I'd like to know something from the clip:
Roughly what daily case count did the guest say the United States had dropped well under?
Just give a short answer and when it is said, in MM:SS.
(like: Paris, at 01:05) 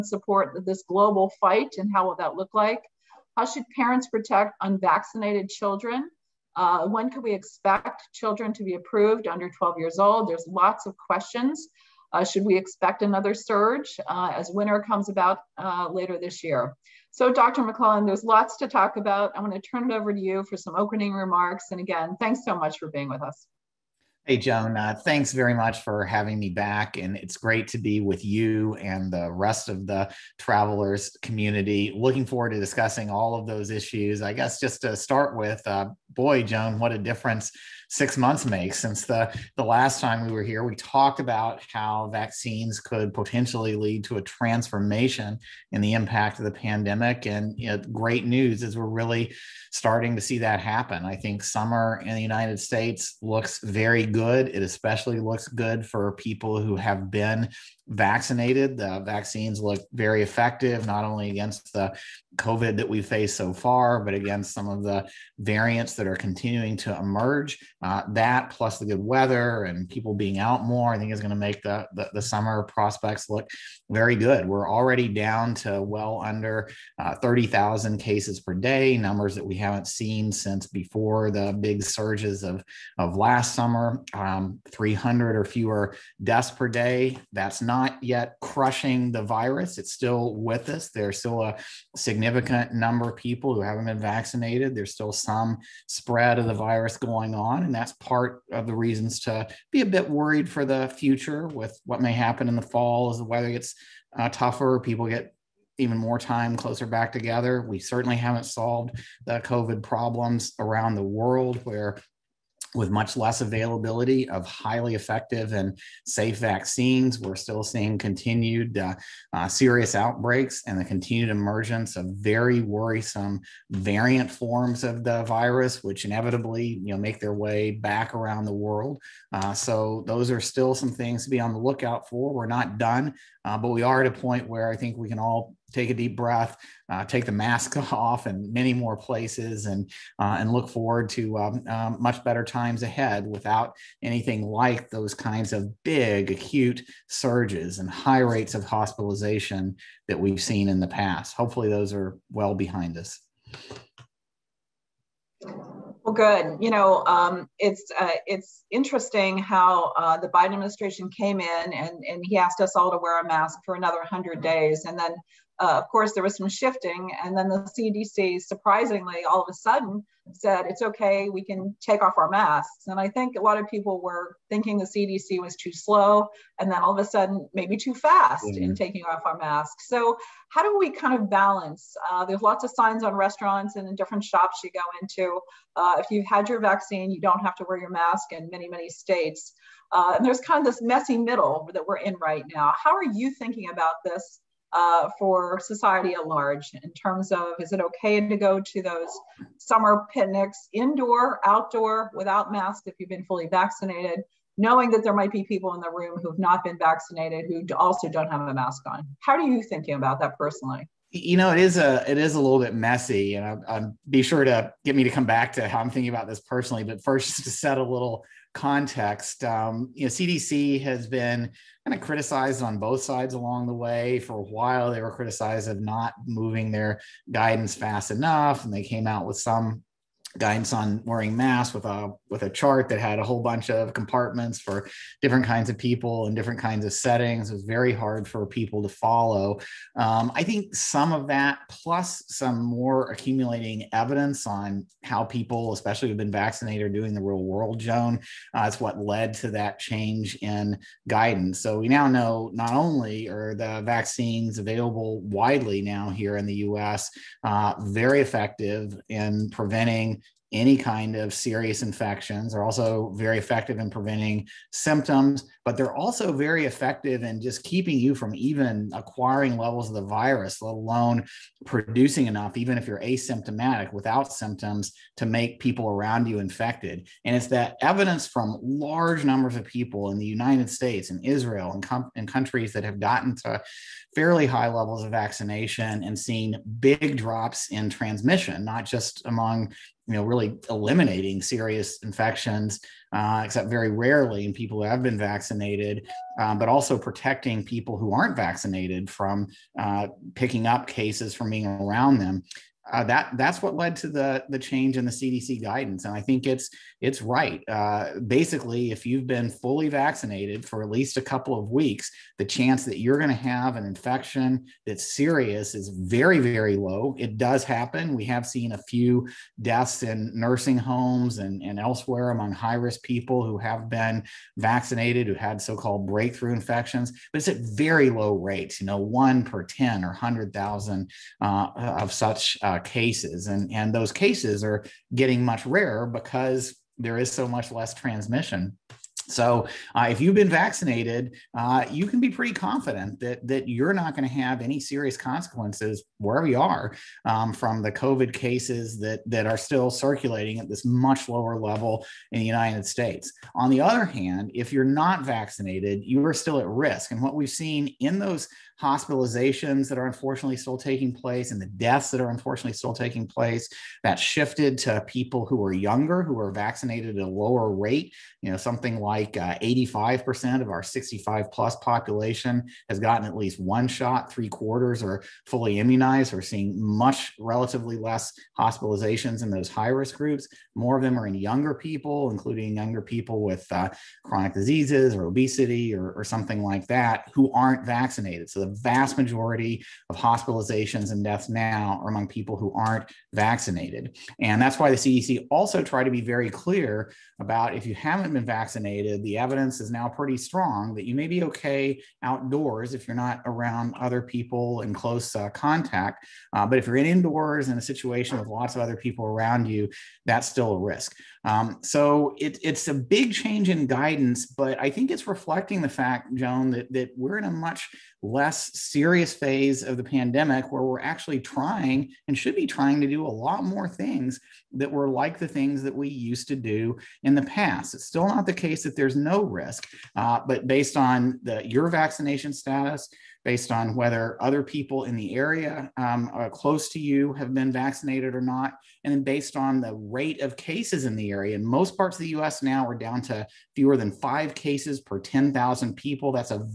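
30,000, at 01:17.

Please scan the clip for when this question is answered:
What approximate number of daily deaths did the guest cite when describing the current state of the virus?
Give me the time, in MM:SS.
01:24.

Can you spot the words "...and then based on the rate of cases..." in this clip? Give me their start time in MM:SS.
07:19.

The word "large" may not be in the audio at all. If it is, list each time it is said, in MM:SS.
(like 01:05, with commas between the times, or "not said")
03:16, 04:38.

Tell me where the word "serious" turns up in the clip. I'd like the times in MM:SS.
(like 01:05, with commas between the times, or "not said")
01:59, 04:21, 04:51, 05:15, 05:44, 06:58.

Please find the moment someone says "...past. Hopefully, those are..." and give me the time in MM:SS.
02:30.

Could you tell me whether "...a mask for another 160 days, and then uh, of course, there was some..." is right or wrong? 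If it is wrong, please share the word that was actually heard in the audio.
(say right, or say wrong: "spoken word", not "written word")
wrong: "100", not "160".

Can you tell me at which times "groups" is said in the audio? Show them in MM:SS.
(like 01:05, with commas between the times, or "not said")
06:20.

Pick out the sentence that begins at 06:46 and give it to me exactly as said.
Uh, but if you're in indoors in a situation with lots of other people around you, that's still a risk.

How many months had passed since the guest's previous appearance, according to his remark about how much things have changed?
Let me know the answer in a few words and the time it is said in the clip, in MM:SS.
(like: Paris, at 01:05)
6, at 00:37.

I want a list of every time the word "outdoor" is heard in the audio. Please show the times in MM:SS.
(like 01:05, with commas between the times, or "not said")
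03:21, 06:42.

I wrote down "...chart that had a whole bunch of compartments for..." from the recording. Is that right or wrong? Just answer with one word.
right.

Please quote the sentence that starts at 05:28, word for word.
You know, one per ten or hundred thousand uh, of such uh, cases.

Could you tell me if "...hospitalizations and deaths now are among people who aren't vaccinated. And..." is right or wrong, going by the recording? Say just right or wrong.
right.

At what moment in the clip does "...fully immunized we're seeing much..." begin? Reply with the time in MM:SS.
06:15.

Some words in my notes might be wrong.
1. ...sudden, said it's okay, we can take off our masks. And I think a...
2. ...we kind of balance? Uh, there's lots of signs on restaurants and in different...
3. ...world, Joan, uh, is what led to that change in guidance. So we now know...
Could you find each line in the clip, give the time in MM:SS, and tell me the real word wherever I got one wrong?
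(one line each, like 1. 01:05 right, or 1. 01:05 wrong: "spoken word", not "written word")
1. 02:49 right
2. 03:00 right
3. 04:07 right.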